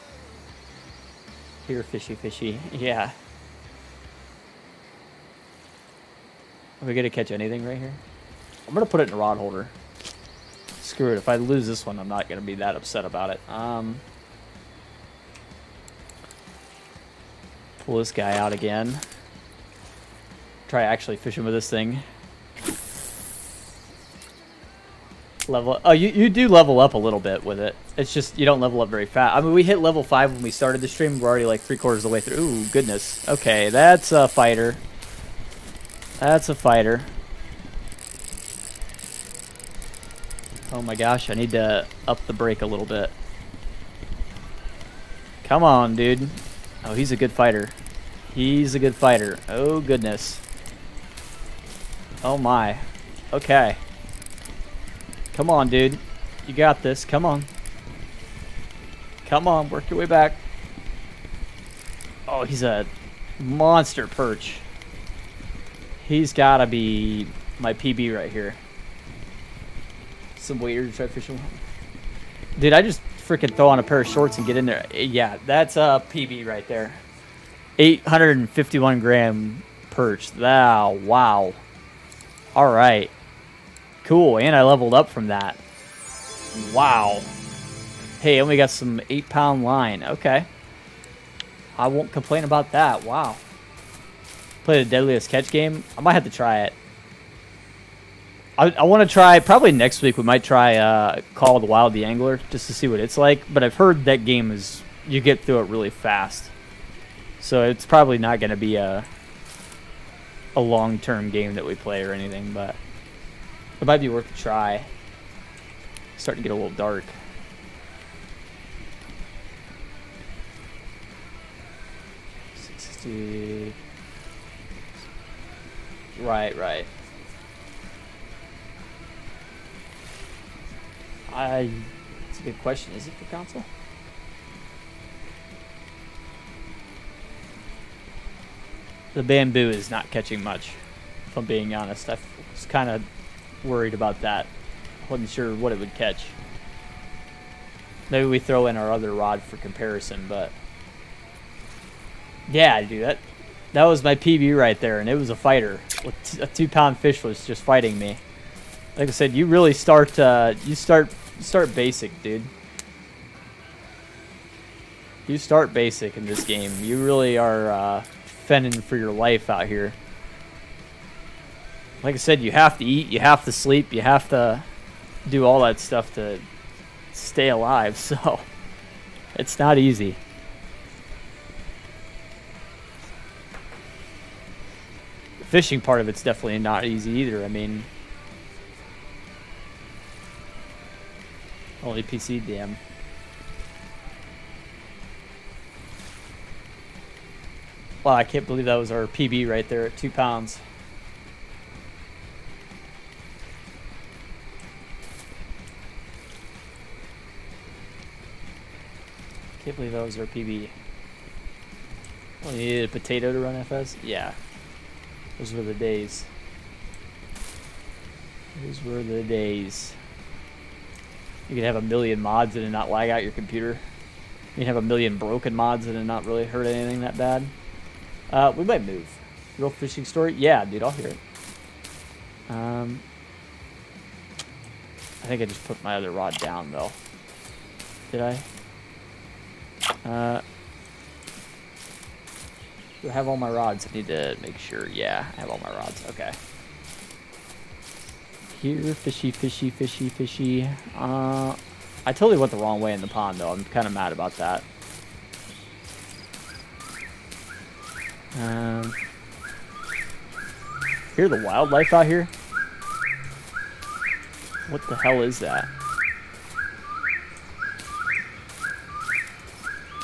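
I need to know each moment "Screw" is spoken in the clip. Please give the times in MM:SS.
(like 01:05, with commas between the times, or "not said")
00:10.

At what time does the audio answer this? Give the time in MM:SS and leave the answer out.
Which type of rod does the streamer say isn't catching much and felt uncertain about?
02:19.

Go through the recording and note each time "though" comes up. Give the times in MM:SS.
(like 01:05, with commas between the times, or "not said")
03:56, 04:13.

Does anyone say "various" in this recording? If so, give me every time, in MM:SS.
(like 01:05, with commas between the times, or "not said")
not said.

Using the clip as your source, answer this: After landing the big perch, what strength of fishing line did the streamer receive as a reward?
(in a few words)
8-pound.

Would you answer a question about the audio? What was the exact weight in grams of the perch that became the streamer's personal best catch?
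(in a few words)
851 grams.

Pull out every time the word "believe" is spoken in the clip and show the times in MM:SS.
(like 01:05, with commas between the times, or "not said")
03:18, 03:29.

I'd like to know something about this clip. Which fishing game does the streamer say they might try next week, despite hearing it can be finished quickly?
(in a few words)
Call of the Wild the Angler.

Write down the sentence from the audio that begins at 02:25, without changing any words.
Wasn't sure what it would catch.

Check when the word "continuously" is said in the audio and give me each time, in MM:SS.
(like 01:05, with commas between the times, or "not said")
not said.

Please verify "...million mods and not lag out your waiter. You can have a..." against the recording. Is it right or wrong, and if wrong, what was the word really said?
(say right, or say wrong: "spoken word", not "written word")
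wrong: "computer", not "waiter".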